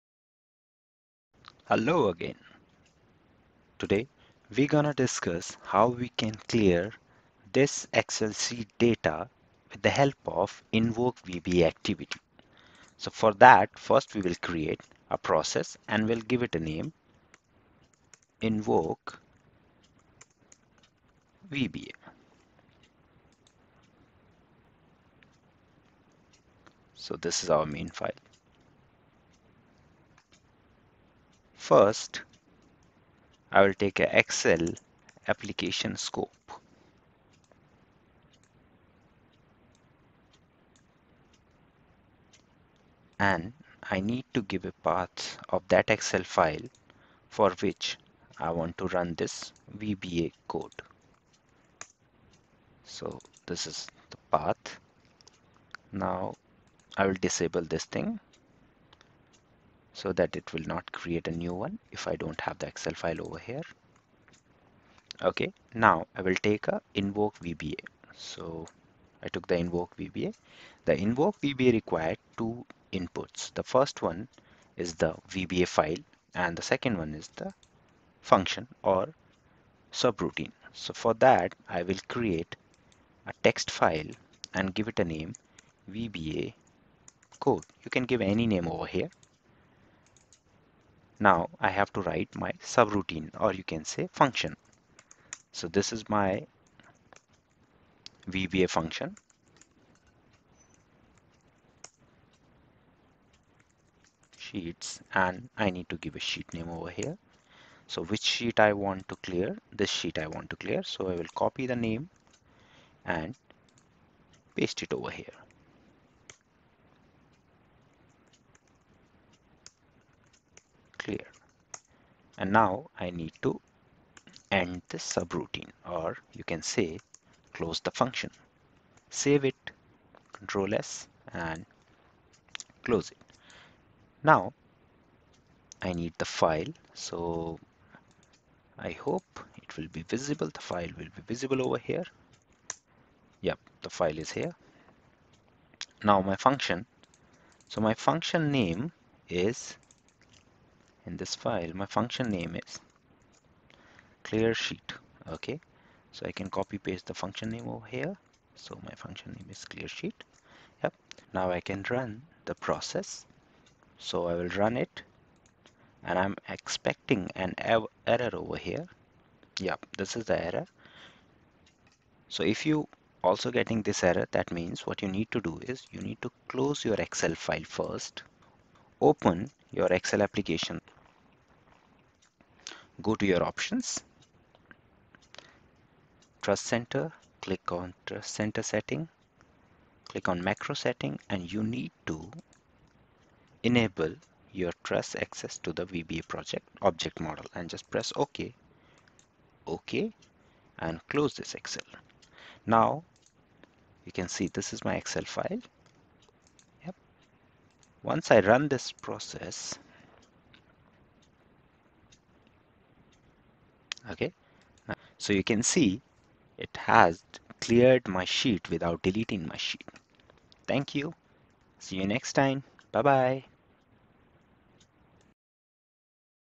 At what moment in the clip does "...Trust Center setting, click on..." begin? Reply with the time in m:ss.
3:08.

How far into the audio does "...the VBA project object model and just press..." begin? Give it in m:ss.
3:15.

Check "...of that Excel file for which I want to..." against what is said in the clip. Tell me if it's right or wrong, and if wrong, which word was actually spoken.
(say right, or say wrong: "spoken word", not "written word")
right.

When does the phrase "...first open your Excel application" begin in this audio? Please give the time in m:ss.
2:57.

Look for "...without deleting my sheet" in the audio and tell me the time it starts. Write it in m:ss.
3:38.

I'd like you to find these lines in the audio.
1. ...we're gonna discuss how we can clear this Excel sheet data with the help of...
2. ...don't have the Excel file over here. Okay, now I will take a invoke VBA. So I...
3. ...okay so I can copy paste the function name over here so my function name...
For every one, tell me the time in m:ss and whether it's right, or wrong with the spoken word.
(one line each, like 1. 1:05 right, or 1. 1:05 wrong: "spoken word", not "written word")
1. 0:04 right
2. 1:02 right
3. 2:35 right.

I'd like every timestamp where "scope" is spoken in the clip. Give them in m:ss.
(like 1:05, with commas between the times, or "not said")
0:35.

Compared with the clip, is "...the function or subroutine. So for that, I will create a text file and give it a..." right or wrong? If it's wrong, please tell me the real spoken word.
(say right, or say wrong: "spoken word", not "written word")
right.